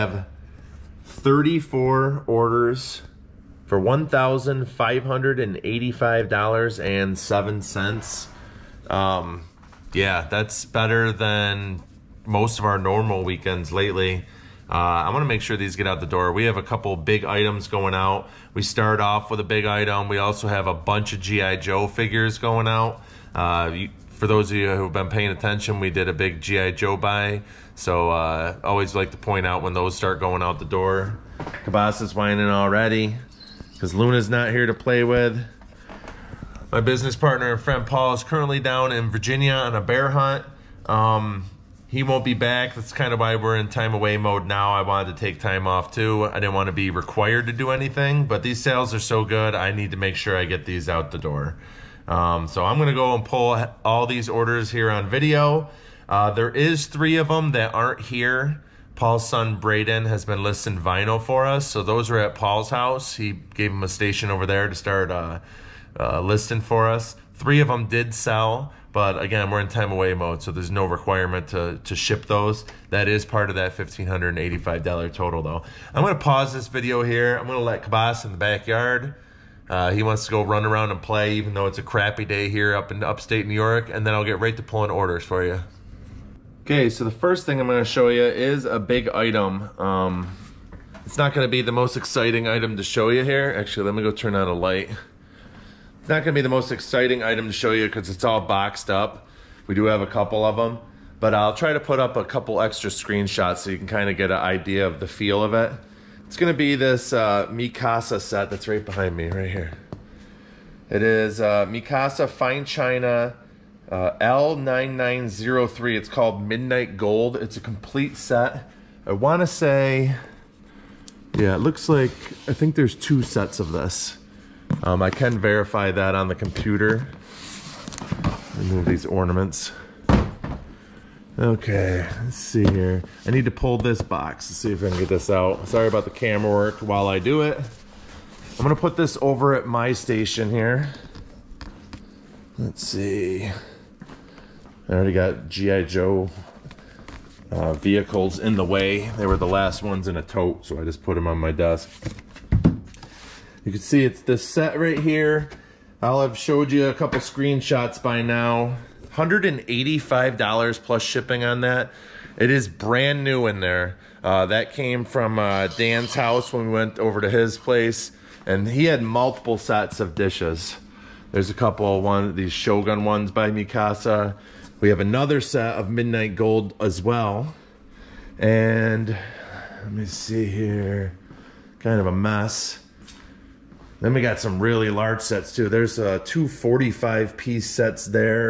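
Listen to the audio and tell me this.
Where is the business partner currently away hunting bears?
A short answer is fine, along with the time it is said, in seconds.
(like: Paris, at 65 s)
Virginia, at 39 s.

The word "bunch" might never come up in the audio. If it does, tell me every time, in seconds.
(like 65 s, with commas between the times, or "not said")
20 s.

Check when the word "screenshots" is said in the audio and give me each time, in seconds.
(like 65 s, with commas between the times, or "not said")
102 s, 157 s.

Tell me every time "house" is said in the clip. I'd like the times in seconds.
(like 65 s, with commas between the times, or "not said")
62 s, 166 s.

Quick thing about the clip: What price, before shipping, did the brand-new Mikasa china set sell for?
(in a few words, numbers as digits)
$185.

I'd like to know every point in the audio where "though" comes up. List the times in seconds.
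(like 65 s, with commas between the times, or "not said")
75 s, 81 s.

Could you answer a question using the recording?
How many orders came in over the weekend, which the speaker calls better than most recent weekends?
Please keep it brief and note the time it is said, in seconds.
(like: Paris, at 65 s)
34, at 1 s.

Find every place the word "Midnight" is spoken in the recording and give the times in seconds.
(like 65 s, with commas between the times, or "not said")
116 s, 175 s.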